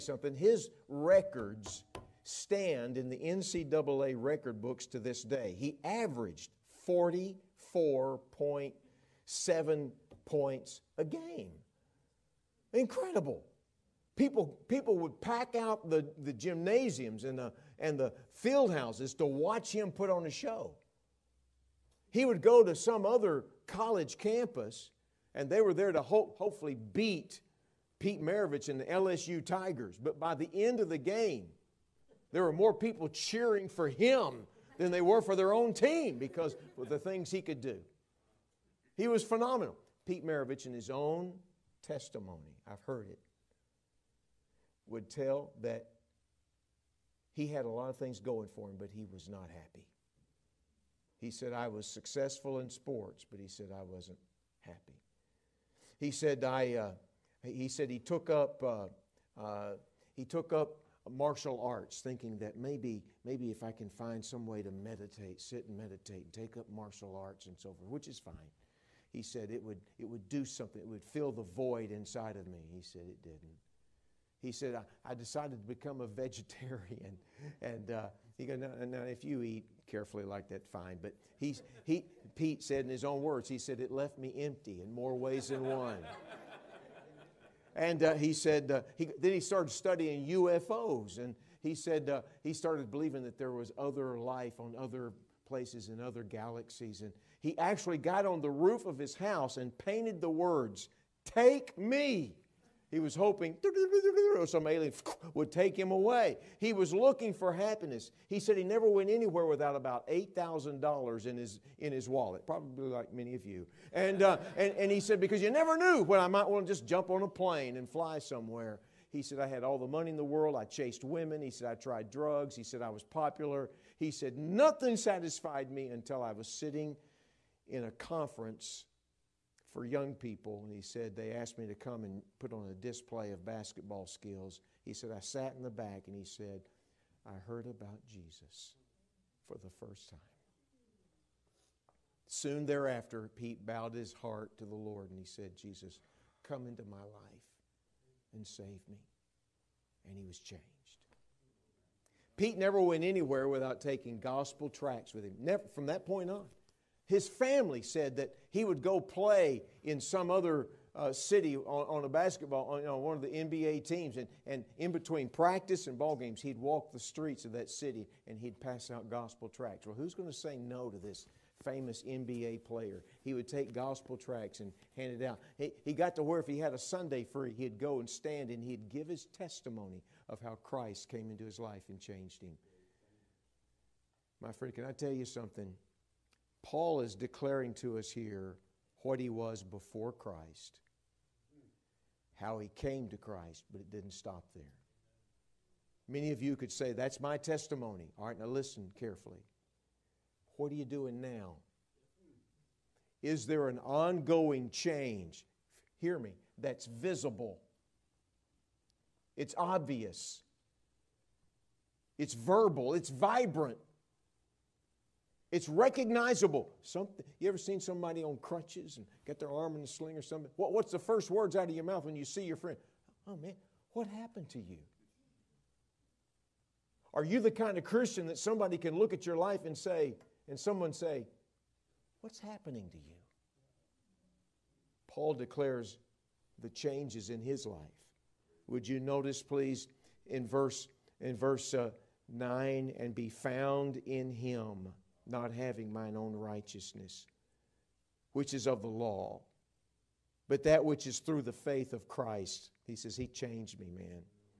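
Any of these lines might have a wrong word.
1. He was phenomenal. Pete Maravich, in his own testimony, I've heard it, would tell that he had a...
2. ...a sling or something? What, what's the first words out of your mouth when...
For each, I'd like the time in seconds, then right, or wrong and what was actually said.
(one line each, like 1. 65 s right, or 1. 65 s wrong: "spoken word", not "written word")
1. 38 s right
2. 219 s right.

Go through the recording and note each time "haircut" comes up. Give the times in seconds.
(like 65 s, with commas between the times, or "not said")
not said.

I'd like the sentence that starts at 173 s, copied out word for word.
He would take gospel tracts and hand it out.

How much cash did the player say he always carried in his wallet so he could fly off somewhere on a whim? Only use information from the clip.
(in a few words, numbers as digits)
$8,000.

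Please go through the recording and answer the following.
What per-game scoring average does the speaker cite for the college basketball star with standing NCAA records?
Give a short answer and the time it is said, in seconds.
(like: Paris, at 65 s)
44.7, at 6 s.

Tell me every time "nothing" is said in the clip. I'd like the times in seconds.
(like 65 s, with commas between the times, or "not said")
124 s.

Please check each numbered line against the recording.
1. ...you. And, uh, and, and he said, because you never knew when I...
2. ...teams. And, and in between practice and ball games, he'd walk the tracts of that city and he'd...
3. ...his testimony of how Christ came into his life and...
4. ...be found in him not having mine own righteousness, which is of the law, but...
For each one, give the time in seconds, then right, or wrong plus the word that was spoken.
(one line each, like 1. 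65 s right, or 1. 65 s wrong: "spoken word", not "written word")
1. 113 s right
2. 163 s wrong: "streets", not "tracts"
3. 179 s right
4. 243 s right.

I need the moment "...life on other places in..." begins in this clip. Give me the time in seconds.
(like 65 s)
94 s.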